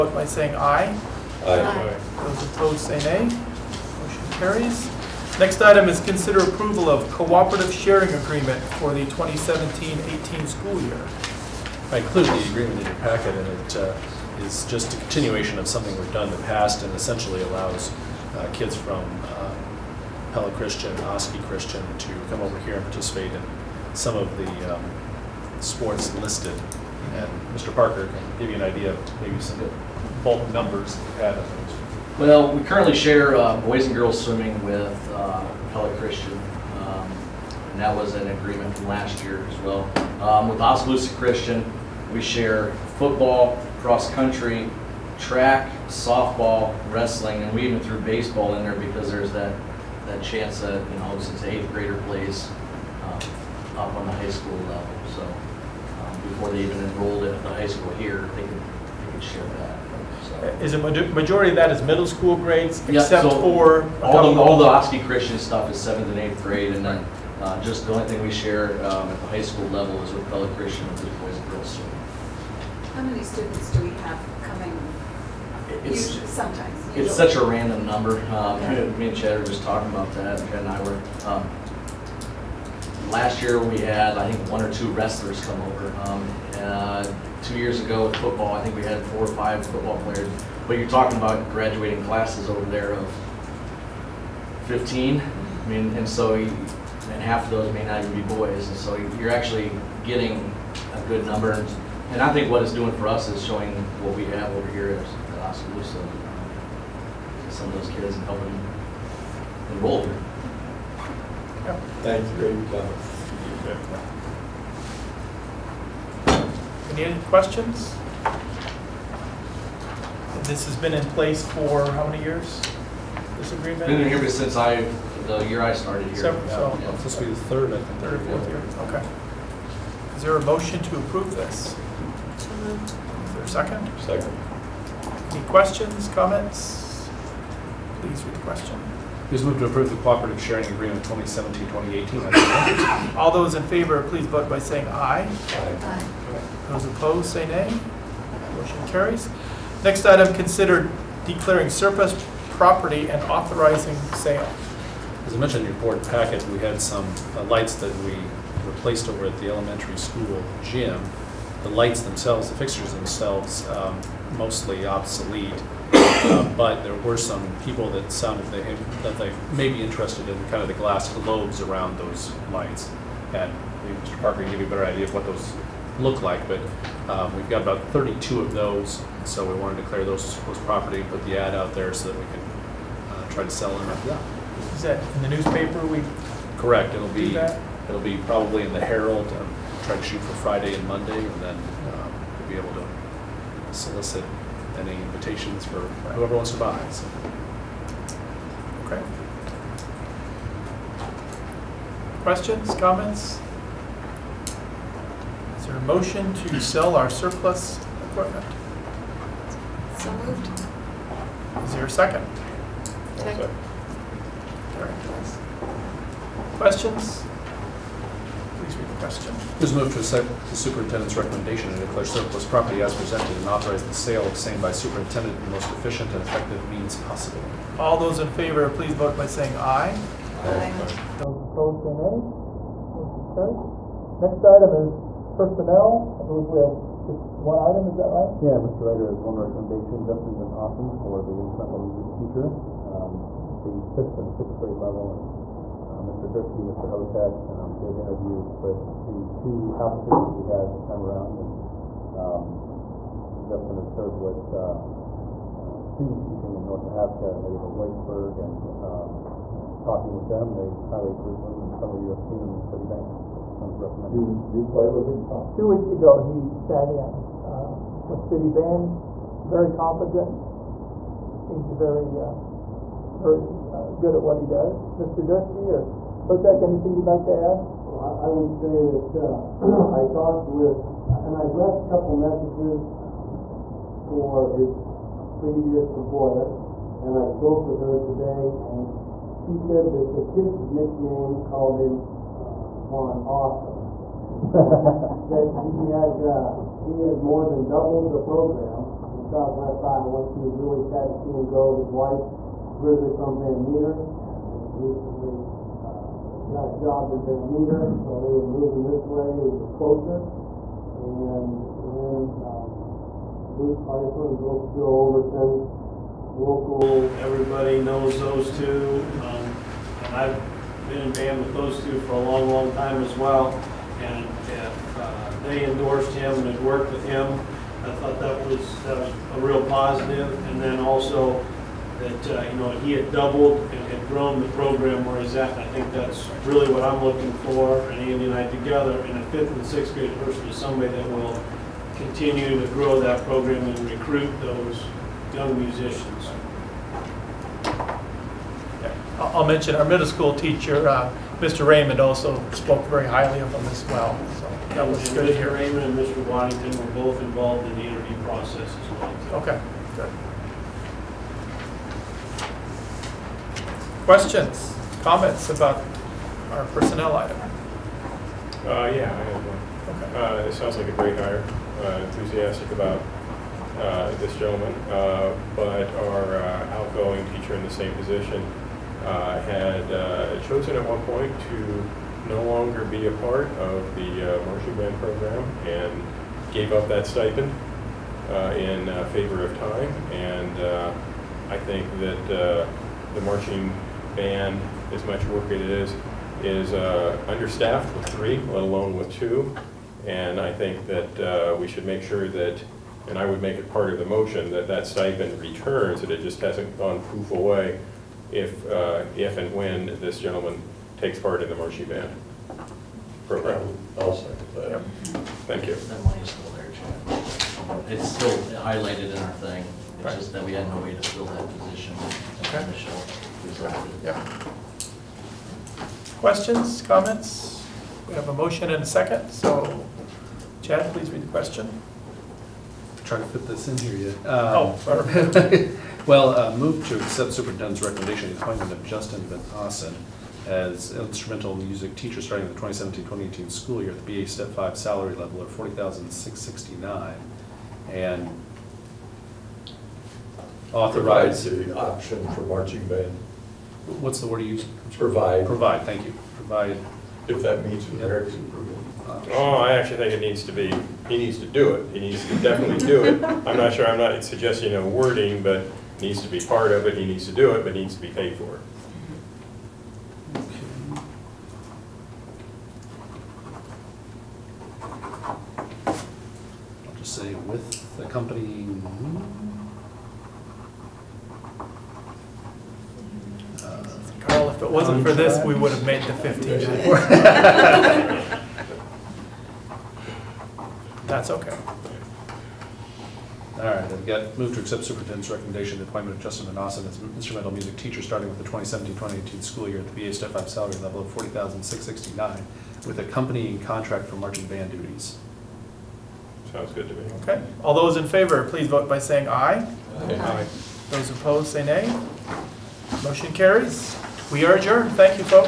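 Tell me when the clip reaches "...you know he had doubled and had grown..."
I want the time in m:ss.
5:32.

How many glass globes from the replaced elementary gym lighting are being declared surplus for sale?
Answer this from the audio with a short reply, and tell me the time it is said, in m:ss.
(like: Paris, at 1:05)
32, at 2:57.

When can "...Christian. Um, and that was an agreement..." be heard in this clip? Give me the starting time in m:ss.
0:35.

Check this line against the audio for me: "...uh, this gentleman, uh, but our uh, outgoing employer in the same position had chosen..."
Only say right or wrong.
wrong.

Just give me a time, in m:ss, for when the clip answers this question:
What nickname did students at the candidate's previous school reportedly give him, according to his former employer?
4:52.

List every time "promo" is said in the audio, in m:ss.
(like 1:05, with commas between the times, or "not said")
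not said.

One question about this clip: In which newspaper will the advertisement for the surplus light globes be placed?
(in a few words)
the Herald.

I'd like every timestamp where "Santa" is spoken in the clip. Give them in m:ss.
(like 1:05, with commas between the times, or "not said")
not said.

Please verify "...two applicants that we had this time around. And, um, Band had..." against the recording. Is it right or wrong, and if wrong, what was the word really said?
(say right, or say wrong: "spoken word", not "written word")
wrong: "Justin", not "Band".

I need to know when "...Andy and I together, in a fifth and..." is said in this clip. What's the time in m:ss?
5:37.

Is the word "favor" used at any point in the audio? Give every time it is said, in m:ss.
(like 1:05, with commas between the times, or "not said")
2:23, 3:48, 6:29, 8:28.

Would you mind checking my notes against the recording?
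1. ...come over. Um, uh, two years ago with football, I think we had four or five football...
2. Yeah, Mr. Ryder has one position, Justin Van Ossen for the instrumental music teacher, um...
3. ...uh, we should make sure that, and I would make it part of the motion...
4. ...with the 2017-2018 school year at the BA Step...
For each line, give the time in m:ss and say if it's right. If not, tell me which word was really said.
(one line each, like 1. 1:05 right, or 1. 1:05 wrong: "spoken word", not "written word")
1. 1:25 right
2. 3:58 wrong: "recommendation", not "position"
3. 6:41 right
4. 8:18 right.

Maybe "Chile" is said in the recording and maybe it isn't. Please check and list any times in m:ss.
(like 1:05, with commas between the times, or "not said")
not said.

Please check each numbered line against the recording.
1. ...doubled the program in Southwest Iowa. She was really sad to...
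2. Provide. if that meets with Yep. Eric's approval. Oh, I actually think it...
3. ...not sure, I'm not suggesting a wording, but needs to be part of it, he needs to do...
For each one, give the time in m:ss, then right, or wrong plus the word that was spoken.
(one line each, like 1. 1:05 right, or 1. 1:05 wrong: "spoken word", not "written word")
1. 4:57 right
2. 7:36 right
3. 7:43 right.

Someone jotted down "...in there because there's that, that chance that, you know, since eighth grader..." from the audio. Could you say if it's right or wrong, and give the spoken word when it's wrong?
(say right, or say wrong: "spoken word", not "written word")
right.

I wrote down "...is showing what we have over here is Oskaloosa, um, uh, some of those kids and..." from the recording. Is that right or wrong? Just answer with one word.
right.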